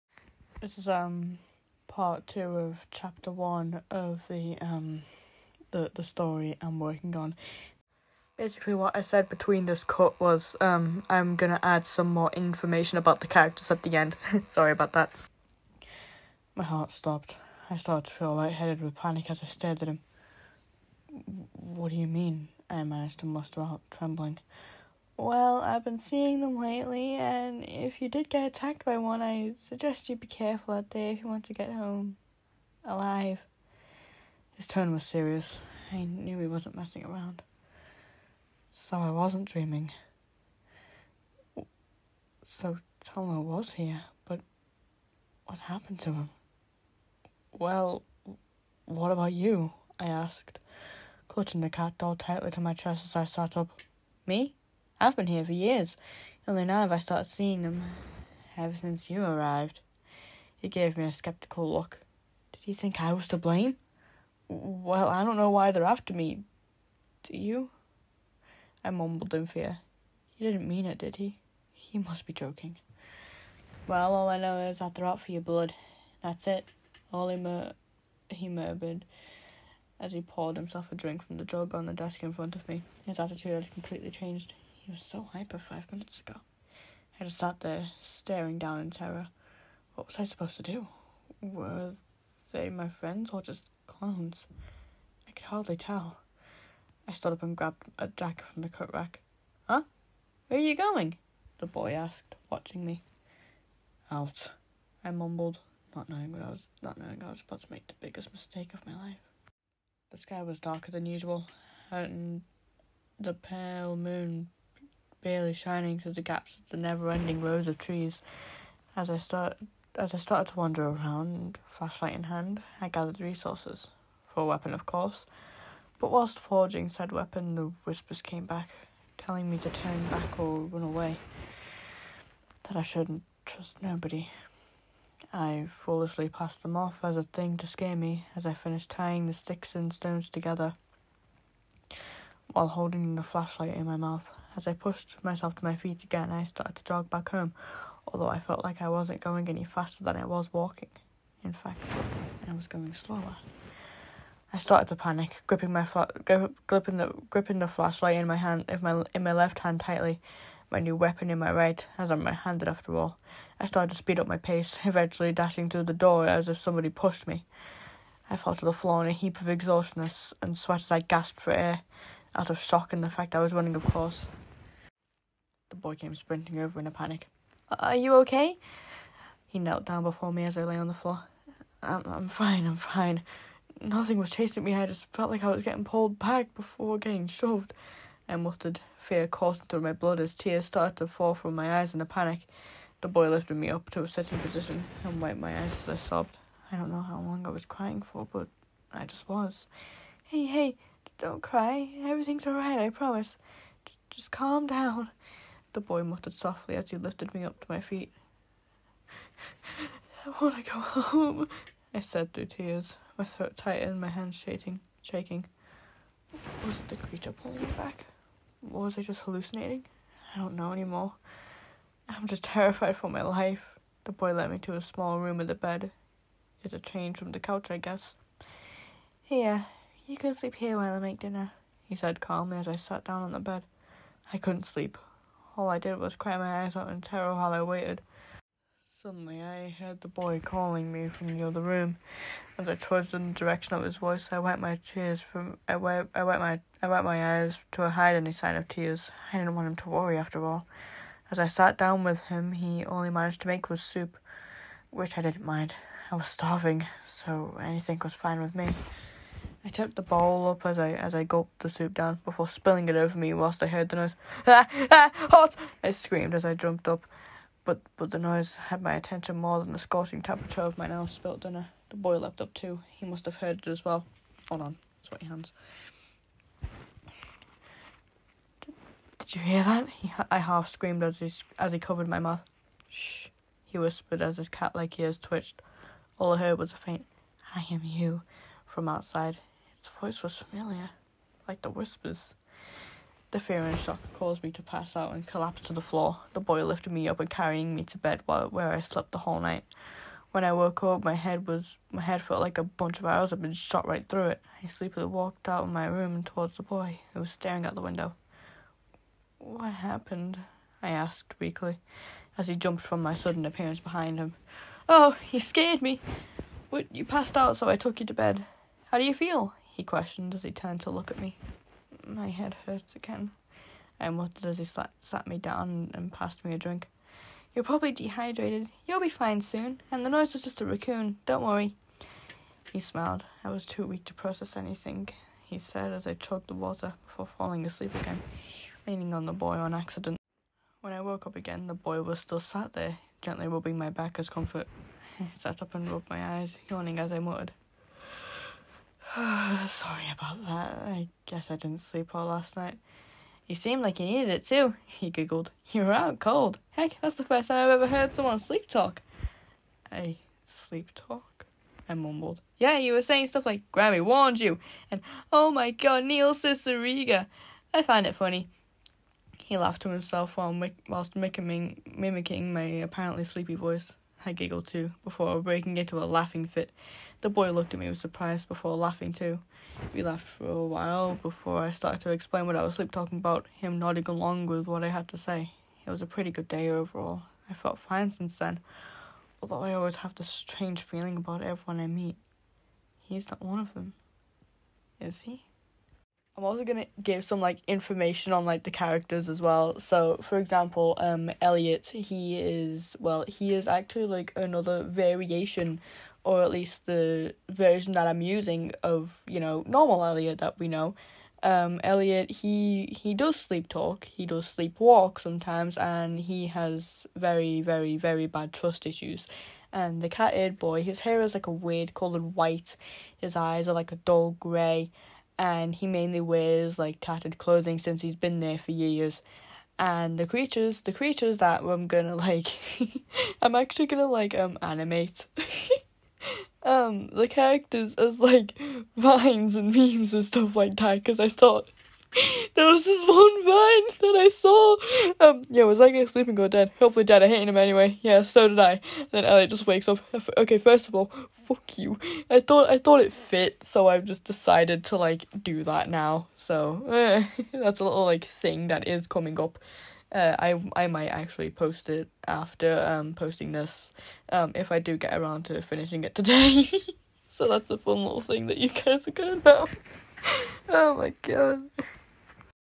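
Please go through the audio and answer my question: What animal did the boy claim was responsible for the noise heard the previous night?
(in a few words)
a raccoon.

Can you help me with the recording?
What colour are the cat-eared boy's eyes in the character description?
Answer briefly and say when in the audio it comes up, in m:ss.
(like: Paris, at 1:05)
dull grey, at 7:03.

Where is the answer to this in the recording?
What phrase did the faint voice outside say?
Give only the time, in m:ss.
4:47.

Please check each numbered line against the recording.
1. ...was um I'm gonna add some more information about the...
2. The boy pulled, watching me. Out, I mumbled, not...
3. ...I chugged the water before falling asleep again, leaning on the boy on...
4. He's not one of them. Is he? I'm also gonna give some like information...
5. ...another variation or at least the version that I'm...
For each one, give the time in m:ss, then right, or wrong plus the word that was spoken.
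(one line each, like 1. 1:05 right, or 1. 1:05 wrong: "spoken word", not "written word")
1. 0:10 right
2. 1:41 wrong: "asked", not "pulled"
3. 5:36 right
4. 6:33 right
5. 6:44 right.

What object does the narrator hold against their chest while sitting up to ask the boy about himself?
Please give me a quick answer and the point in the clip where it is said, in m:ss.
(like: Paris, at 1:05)
cat doll, at 0:51.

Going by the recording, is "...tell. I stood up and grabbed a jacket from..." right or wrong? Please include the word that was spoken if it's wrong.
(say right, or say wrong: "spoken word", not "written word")
right.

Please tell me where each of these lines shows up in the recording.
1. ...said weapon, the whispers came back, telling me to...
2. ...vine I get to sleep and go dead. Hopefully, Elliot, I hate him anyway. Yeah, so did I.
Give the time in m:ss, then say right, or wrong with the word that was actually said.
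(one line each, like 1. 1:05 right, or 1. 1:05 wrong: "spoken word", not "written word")
1. 2:06 right
2. 7:23 wrong: "Dad", not "Elliot".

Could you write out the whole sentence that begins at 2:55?
The boy came sprinting over in a panic.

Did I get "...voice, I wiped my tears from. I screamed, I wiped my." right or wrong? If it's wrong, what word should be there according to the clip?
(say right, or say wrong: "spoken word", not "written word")
wrong: "wiped", not "screamed".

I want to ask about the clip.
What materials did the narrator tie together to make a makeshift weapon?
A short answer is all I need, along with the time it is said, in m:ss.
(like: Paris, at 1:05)
sticks and stones, at 2:19.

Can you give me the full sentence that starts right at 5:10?
I asked weakly, as he jumped from my sudden appearance behind him.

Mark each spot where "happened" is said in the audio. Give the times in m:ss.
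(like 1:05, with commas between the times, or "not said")
0:45, 5:09.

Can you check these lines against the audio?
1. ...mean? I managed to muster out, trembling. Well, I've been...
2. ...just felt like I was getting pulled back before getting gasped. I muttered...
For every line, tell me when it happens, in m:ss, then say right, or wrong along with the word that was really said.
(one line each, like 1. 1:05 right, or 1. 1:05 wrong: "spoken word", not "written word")
1. 0:22 right
2. 3:04 wrong: "shoved", not "gasped".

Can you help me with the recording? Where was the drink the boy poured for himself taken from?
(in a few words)
the jug.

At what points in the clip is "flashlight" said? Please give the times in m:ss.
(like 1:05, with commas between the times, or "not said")
2:01, 2:23, 2:37.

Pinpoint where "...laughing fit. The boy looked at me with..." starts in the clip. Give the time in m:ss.
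6:16.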